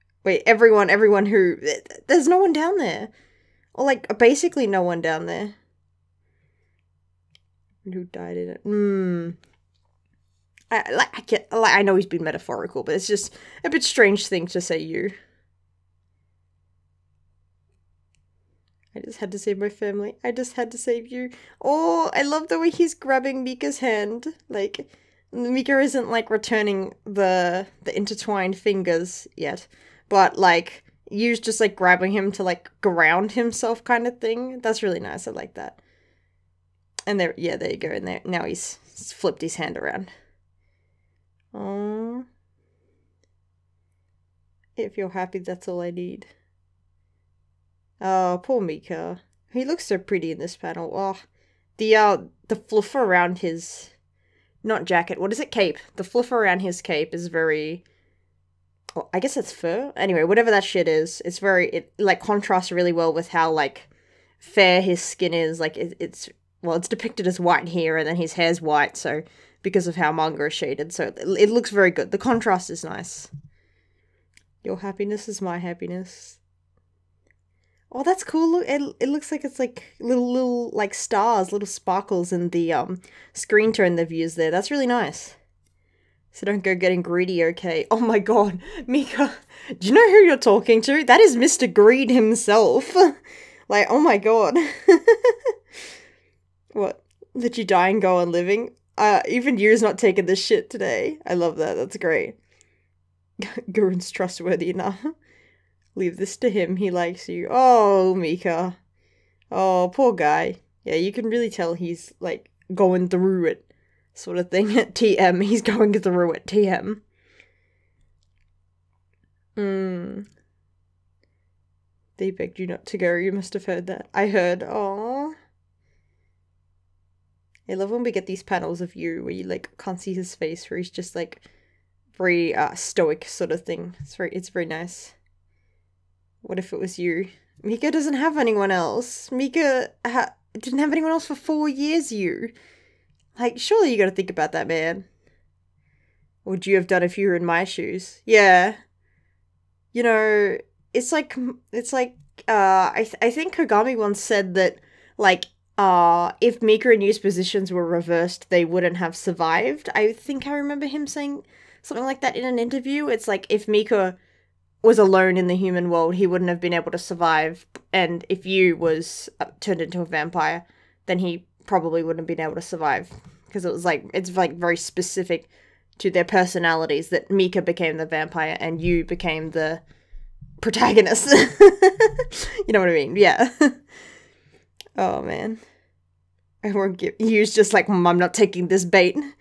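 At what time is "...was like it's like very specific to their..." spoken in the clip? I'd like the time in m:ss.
2:53.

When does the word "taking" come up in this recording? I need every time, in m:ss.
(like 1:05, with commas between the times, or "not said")
1:39, 3:08.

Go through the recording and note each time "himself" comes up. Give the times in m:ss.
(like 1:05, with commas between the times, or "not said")
0:33, 1:32.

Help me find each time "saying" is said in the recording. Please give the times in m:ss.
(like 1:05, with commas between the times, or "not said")
2:41.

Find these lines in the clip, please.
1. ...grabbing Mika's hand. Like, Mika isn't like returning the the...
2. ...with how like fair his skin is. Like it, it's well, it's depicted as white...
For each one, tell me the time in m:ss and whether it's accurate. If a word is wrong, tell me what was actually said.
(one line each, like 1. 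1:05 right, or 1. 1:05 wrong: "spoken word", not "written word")
1. 0:22 right
2. 1:03 right.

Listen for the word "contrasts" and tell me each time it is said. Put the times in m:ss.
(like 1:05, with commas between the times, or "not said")
1:02, 1:12.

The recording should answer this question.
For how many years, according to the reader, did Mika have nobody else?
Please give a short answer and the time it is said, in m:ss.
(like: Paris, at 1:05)
4, at 2:21.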